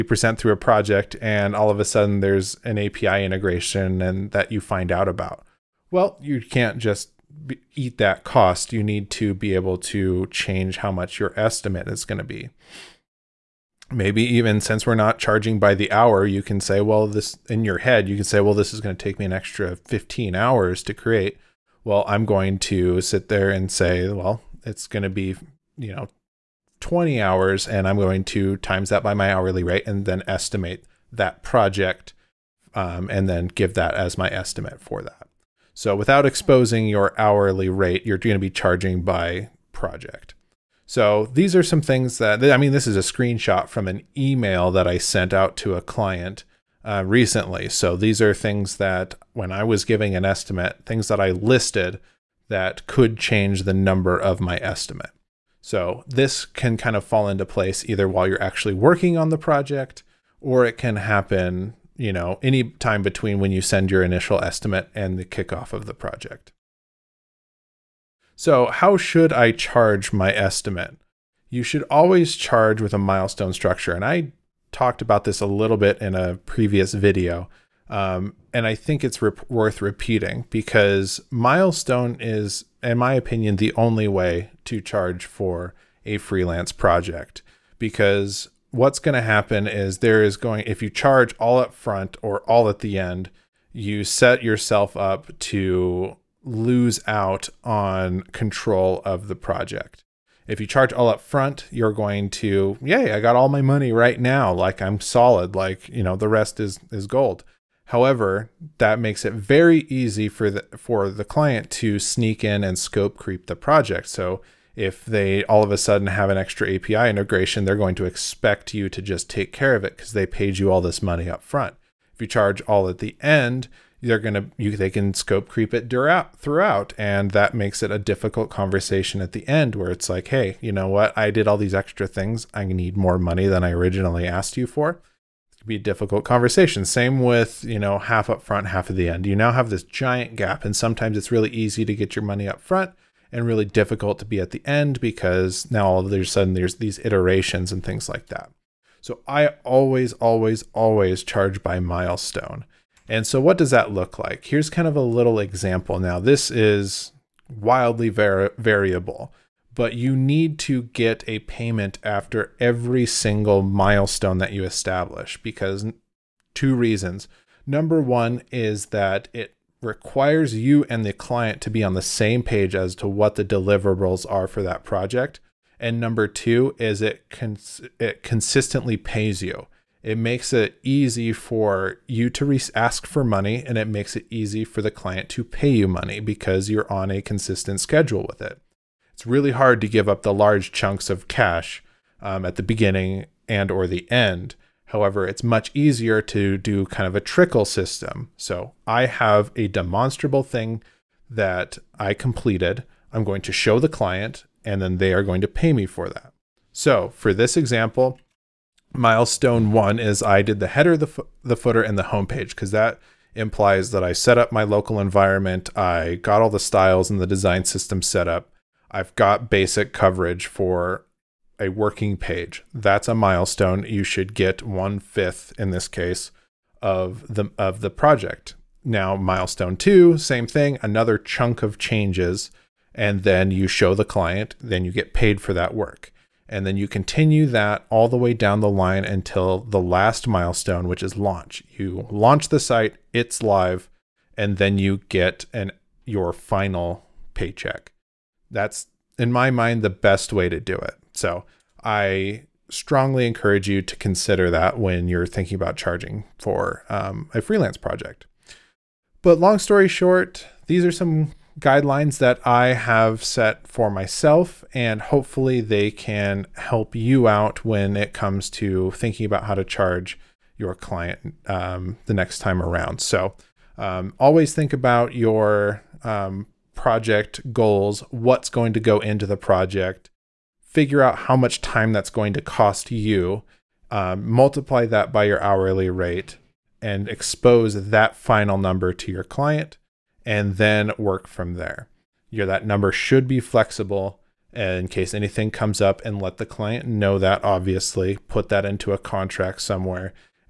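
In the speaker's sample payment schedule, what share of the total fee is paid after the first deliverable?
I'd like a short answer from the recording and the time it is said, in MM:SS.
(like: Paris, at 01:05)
One fifth, at 03:44.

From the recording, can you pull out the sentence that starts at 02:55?
And number two is it cons- it consistently pays you.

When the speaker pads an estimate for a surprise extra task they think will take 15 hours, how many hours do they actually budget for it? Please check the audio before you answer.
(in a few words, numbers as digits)
20 hours.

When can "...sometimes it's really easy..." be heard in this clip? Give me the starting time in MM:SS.
02:20.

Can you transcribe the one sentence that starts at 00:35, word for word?
So without exposing your hourly rate, you're going to be charging by project.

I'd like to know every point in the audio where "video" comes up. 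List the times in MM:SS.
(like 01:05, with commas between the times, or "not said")
01:16.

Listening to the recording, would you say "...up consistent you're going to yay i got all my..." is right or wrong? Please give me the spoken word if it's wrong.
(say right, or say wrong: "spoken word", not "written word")
wrong: "front", not "consistent".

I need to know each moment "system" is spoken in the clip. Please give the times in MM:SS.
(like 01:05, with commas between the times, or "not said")
03:17, 03:37.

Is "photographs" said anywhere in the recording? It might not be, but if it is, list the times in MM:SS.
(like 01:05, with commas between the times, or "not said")
not said.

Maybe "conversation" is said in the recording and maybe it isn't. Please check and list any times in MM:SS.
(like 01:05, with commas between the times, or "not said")
02:08, 02:16.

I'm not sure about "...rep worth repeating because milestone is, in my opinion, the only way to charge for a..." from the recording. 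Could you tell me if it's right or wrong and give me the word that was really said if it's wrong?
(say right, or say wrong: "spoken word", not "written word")
right.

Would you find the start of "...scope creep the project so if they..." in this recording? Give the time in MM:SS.
01:52.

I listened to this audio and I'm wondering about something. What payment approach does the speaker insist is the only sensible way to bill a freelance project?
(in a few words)
Milestone structure.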